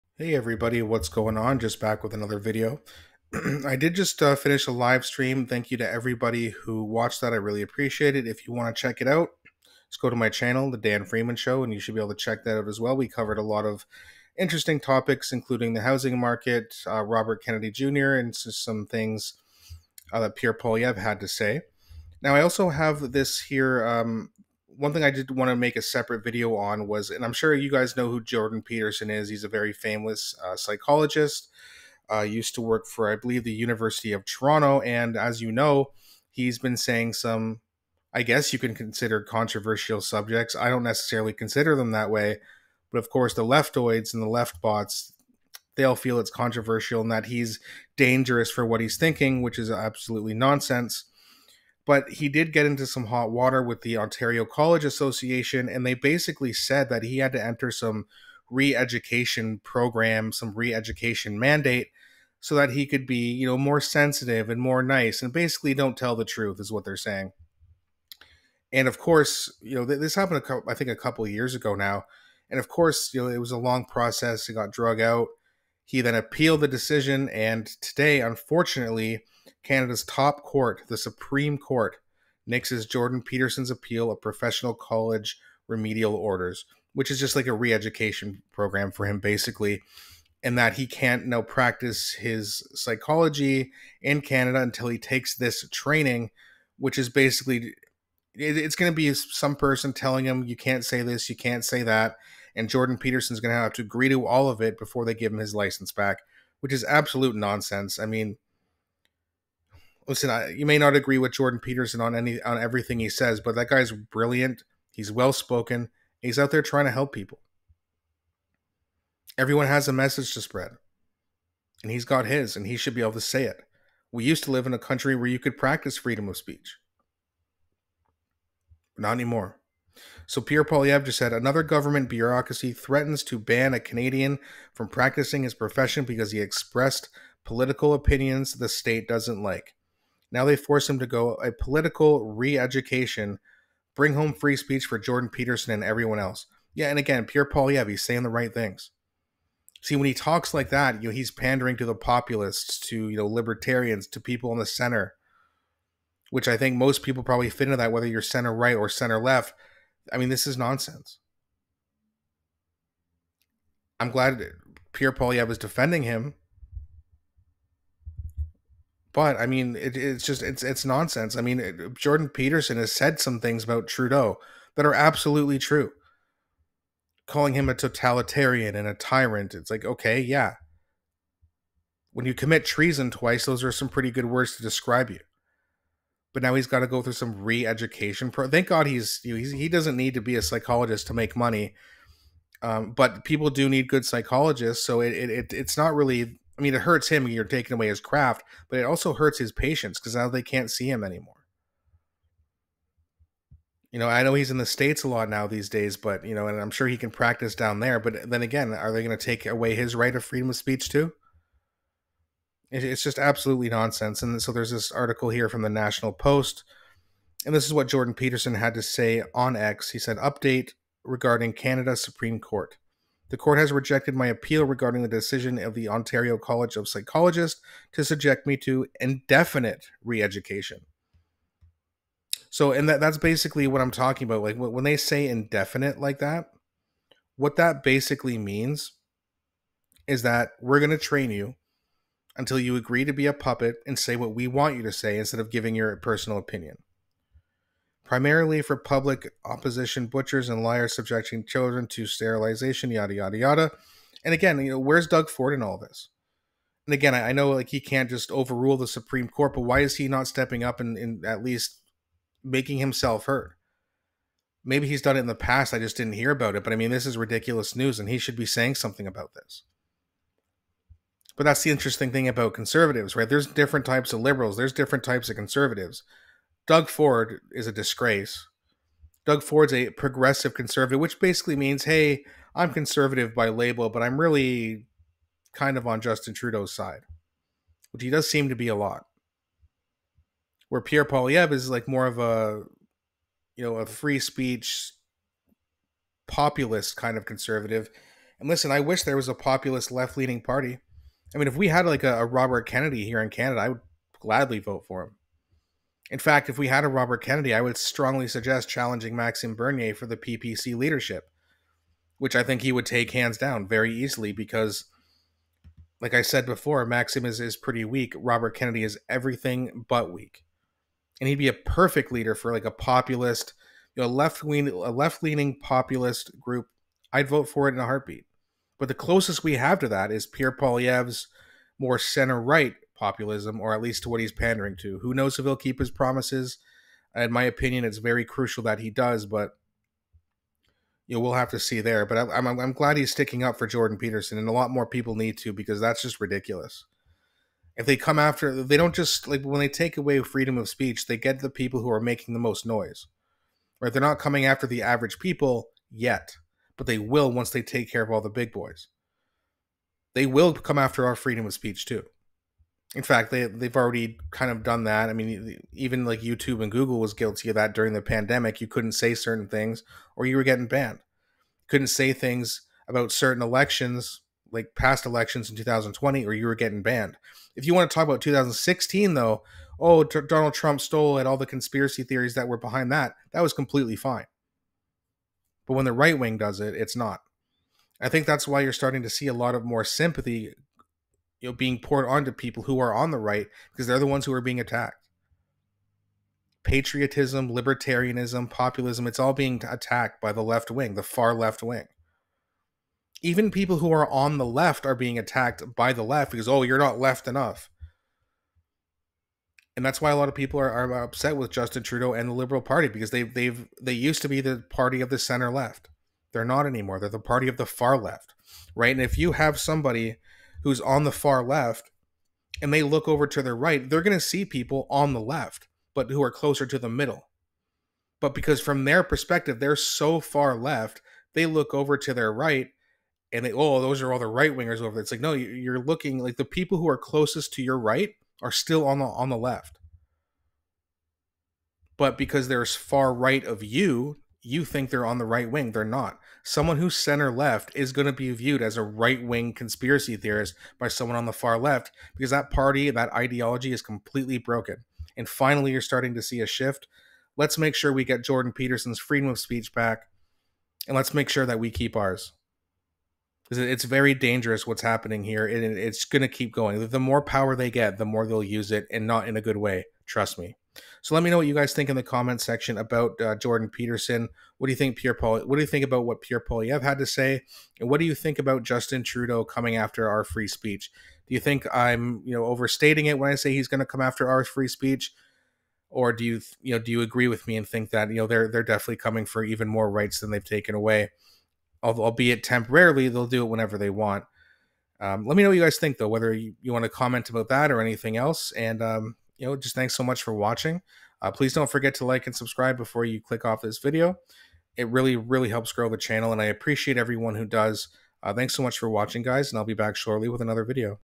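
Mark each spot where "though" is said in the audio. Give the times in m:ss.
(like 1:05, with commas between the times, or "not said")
6:19, 8:15.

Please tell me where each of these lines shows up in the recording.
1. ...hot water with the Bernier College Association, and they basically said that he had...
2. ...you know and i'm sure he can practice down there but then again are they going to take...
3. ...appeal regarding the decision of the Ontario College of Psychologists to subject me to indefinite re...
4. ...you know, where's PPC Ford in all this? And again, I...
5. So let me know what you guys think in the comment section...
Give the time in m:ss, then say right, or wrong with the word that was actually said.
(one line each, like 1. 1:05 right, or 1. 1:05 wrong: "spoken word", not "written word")
1. 0:53 wrong: "Ontario", not "Bernier"
2. 3:26 right
3. 3:44 right
4. 4:14 wrong: "Doug", not "PPC"
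5. 7:51 right.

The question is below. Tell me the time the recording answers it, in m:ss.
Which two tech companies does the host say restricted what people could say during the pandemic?
6:06.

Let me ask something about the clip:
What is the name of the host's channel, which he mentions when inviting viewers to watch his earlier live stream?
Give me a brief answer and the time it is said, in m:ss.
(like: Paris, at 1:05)
The Dan Freeman Show, at 0:10.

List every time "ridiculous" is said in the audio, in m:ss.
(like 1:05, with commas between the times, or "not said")
4:27, 5:46.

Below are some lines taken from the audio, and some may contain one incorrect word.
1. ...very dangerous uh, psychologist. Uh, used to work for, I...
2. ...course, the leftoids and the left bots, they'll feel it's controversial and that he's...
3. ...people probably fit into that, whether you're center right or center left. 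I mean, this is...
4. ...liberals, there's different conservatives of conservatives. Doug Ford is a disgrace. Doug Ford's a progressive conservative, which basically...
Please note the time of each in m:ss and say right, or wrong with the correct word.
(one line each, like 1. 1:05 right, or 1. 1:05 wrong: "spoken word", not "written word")
1. 0:29 wrong: "famous", not "dangerous"
2. 0:43 right
3. 2:37 right
4. 4:34 wrong: "types", not "conservatives".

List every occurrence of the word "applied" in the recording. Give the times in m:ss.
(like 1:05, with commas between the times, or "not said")
not said.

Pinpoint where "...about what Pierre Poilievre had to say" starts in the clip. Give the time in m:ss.
7:55.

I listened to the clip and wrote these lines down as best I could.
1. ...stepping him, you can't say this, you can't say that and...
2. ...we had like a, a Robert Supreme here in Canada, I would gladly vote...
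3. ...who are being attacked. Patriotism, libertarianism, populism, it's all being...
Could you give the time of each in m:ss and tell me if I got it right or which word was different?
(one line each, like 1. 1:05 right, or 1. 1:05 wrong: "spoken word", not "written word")
1. 1:39 wrong: "telling", not "stepping"
2. 5:01 wrong: "Kennedy", not "Supreme"
3. 6:34 right.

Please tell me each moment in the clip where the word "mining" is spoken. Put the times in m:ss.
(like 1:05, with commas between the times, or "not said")
not said.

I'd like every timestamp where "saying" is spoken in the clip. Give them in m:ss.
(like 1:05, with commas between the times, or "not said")
0:36, 1:06, 2:28, 4:28.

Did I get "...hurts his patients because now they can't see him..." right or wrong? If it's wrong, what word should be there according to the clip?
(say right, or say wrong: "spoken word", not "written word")
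right.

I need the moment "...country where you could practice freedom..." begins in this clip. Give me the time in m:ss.
2:04.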